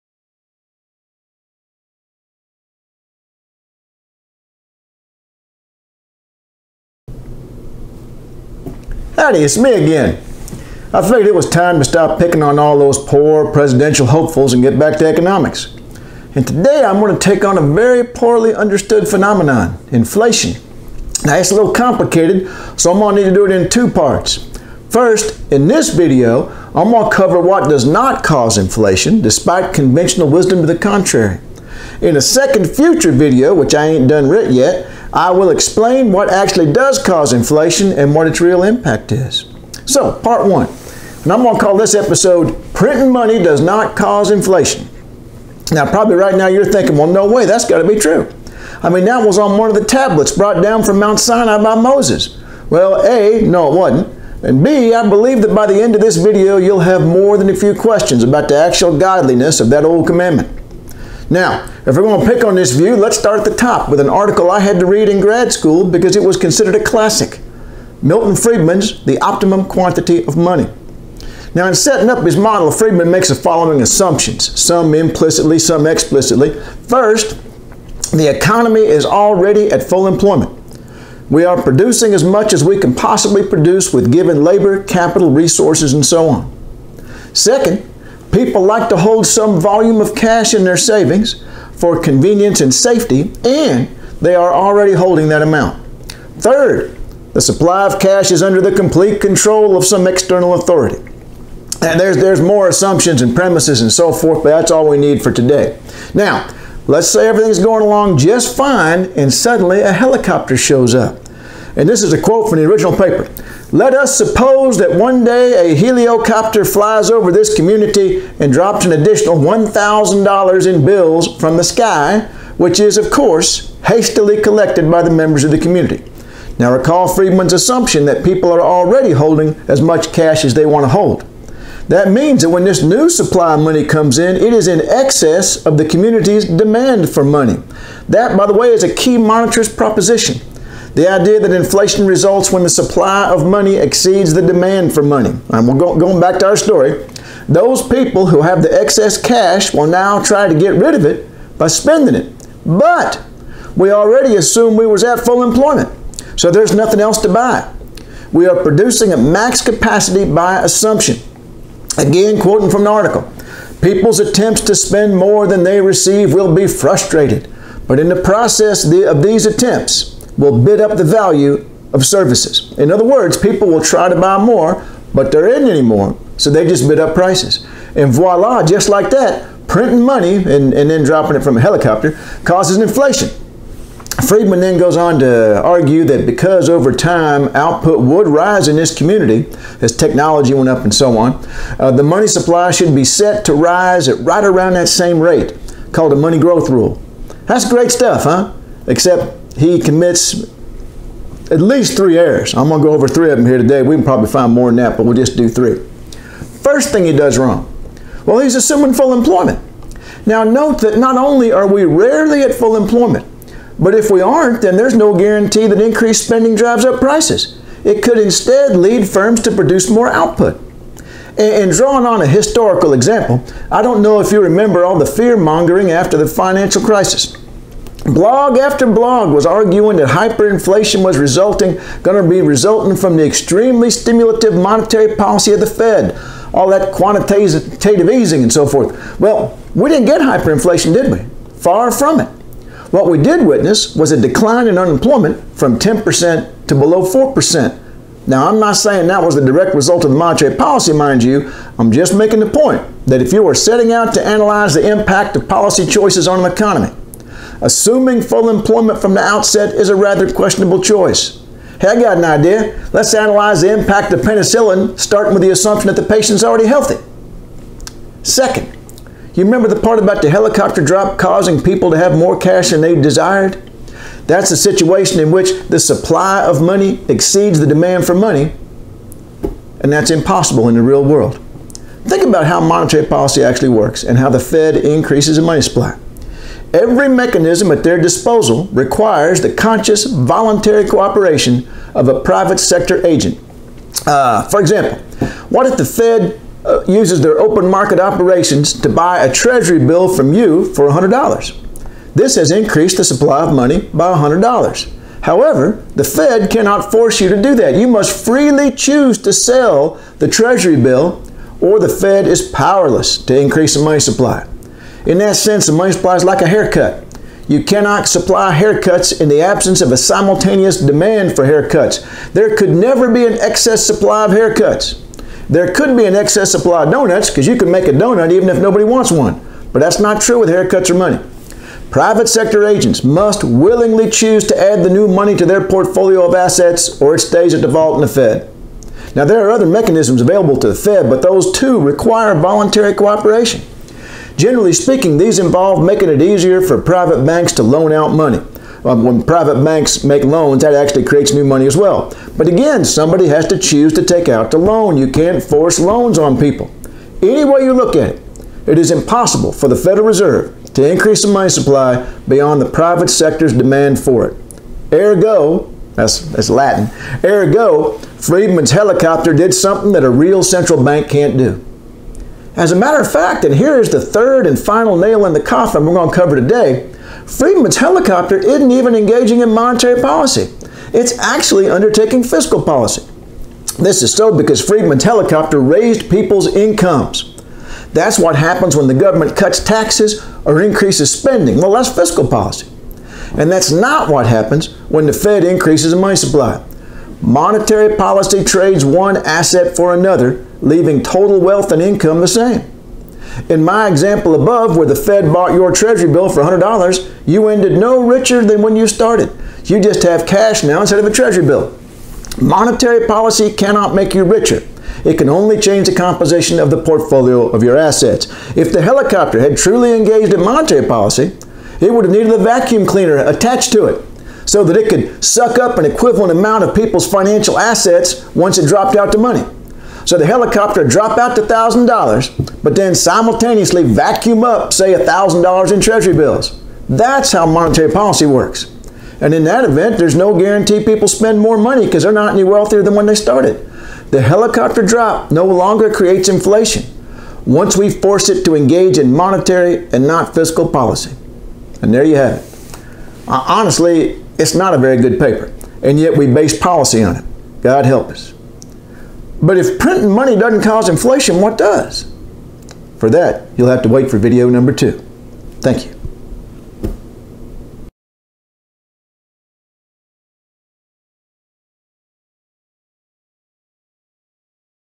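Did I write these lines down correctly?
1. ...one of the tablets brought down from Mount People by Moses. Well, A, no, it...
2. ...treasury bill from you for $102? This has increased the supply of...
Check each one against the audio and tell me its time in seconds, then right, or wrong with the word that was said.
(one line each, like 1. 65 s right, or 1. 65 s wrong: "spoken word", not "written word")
1. 49 s wrong: "Sinai", not "People"
2. 299 s wrong: "100", not "102".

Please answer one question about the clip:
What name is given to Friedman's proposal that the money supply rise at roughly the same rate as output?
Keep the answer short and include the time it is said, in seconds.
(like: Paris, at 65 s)
money growth rule, at 196 s.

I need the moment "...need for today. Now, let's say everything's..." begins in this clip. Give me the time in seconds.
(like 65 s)
104 s.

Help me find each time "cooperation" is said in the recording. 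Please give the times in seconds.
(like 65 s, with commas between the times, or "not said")
290 s, 342 s.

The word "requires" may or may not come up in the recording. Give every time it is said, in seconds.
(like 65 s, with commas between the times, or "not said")
288 s, 341 s.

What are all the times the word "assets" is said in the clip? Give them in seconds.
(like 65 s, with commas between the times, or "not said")
336 s, 399 s, 417 s, 427 s.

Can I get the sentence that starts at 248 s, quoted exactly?
Now, I'm not saying that was the direct result of the monetary policy, mind you.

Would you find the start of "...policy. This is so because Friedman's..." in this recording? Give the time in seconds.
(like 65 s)
382 s.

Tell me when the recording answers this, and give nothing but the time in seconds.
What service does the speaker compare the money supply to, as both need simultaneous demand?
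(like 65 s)
316 s.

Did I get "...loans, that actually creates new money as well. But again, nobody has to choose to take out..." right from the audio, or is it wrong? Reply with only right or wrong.
wrong.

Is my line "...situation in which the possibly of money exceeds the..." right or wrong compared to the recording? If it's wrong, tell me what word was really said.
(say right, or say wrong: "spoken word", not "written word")
wrong: "supply", not "possibly".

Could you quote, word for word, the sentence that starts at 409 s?
You just have cash now instead of a Treasury bill.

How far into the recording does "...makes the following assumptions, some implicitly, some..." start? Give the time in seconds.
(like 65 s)
73 s.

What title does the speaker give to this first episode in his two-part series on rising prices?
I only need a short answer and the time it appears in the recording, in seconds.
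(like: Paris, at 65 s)
Printing Money Does Not Cause Inflation, at 42 s.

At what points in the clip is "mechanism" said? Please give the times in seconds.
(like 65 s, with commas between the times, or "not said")
287 s, 339 s.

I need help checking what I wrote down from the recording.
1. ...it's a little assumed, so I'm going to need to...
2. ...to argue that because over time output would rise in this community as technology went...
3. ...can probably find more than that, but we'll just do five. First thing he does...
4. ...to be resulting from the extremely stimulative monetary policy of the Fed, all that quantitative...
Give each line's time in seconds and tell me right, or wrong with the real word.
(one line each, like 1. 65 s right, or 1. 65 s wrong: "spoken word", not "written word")
1. 21 s wrong: "complicated", not "assumed"
2. 185 s right
3. 203 s wrong: "three", not "five"
4. 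232 s right.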